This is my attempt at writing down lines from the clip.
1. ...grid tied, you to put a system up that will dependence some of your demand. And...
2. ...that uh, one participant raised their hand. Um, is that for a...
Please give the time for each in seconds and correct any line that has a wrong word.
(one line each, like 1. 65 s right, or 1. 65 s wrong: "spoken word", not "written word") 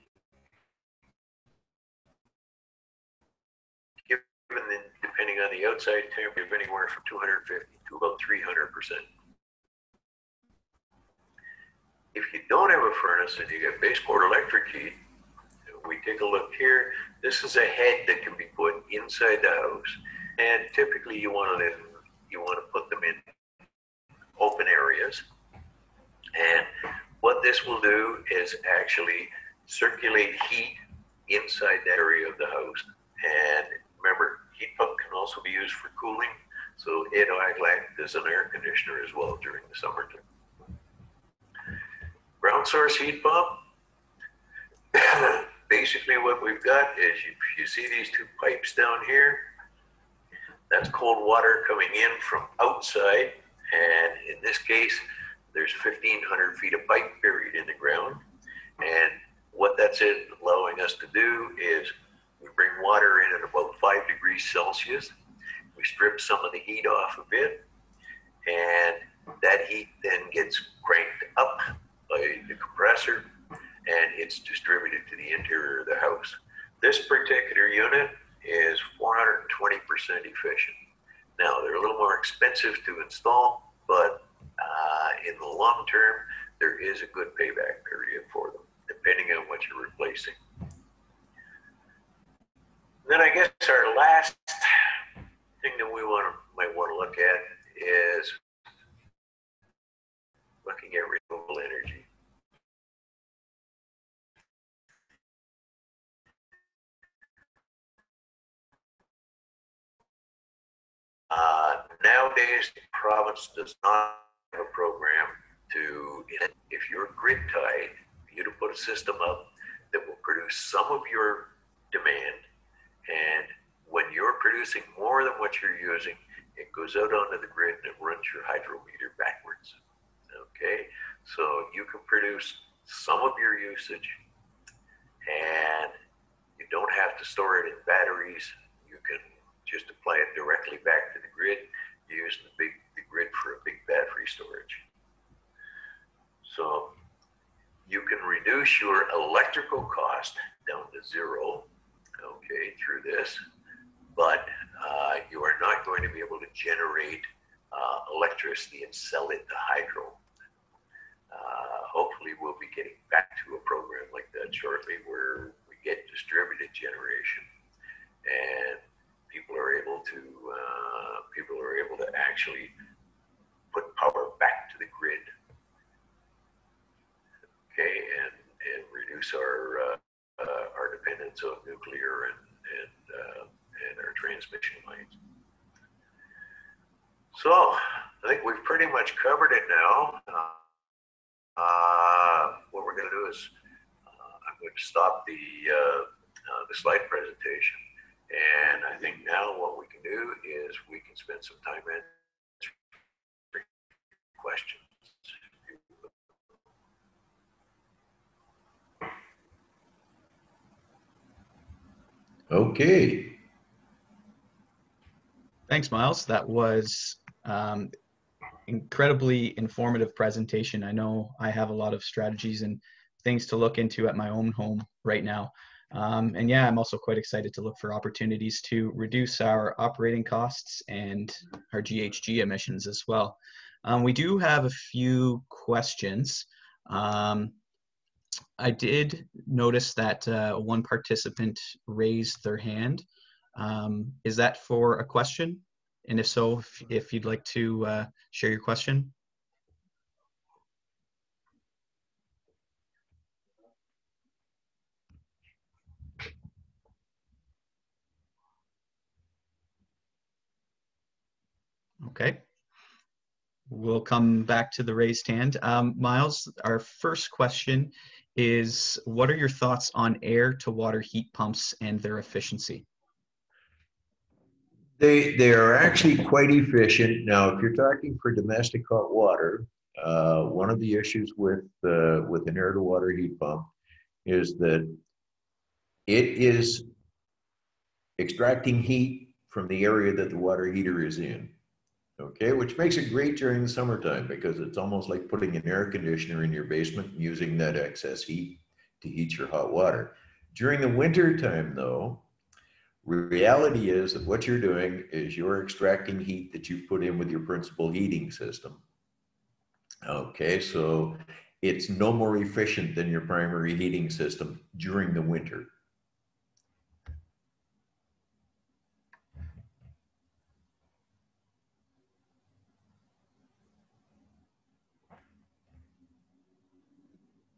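1. 117 s wrong: "produce", not "dependence"
2. 239 s right.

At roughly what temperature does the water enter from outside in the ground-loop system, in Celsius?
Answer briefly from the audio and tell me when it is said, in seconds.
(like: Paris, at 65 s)
5 degrees Celsius, at 63 s.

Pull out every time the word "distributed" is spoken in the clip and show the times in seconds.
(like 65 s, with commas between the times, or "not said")
74 s, 166 s.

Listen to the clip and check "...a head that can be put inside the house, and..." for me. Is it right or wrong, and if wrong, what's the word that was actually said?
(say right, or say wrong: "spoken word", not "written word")
right.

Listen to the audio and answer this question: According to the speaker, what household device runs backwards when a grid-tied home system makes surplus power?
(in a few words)
hydrometer.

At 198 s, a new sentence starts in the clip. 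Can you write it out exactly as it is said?
And I think now what we can do is we can spend some time answering questions.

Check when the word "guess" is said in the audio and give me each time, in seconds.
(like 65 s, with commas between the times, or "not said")
93 s.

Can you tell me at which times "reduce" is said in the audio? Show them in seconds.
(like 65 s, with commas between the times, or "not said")
148 s, 178 s, 228 s.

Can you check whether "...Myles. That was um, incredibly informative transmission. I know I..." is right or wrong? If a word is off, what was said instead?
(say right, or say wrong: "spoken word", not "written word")
wrong: "presentation", not "transmission".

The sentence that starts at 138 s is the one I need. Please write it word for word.
You can just apply it directly back grid, using the big the grid for a big battery storage.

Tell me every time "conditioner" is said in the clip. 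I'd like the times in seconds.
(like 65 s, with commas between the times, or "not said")
38 s, 295 s.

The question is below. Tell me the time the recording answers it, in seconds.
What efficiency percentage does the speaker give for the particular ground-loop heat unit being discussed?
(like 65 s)
79 s.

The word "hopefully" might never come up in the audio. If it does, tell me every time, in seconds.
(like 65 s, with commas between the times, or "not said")
161 s.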